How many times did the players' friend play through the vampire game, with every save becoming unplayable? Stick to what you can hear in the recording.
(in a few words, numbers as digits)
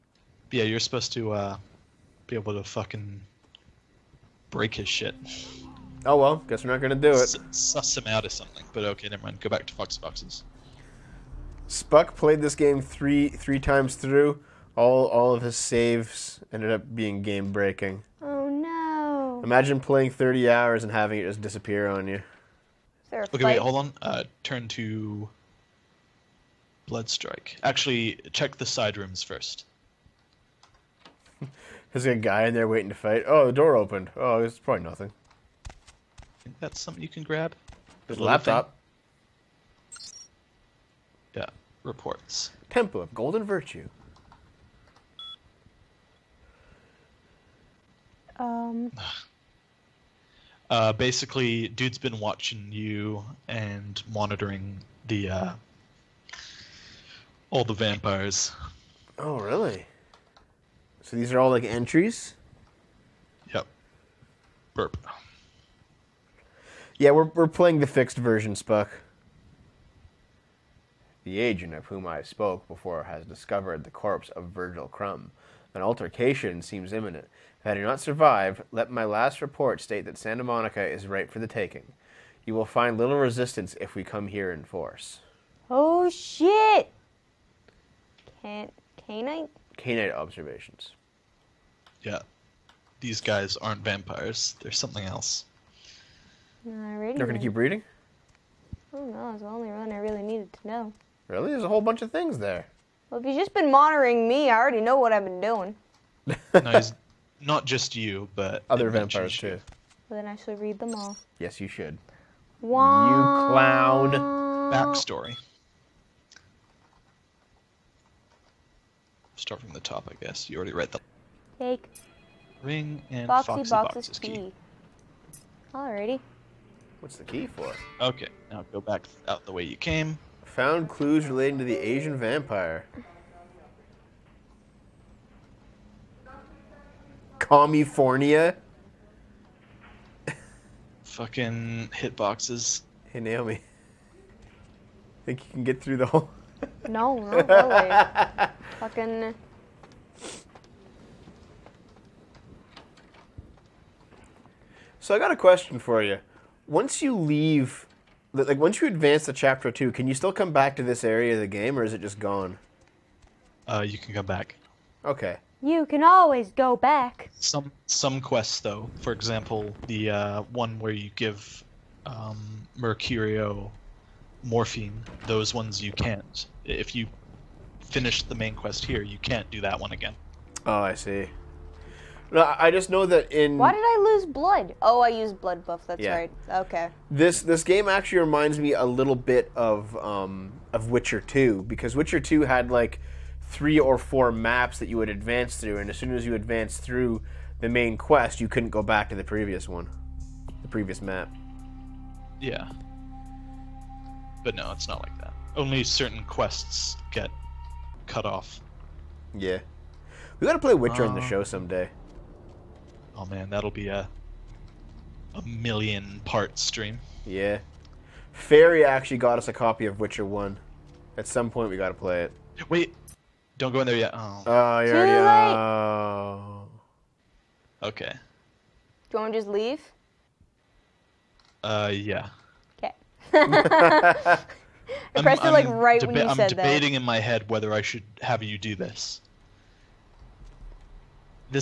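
3.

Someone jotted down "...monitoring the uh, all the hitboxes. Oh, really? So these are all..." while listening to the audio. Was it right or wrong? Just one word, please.
wrong.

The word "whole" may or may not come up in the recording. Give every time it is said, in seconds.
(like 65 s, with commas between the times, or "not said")
101 s, 146 s.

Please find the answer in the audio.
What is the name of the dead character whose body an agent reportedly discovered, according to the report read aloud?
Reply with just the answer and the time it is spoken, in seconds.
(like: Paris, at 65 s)
Virgil Crumb, at 74 s.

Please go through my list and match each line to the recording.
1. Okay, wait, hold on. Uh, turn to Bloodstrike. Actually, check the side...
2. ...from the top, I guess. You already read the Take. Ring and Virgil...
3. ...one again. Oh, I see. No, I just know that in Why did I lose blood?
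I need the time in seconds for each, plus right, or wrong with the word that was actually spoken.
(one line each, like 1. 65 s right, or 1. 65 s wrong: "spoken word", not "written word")
1. 23 s right
2. 119 s wrong: "Foxy", not "Virgil"
3. 179 s right.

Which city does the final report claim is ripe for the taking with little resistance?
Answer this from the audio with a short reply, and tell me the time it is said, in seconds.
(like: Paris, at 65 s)
Santa Monica, at 80 s.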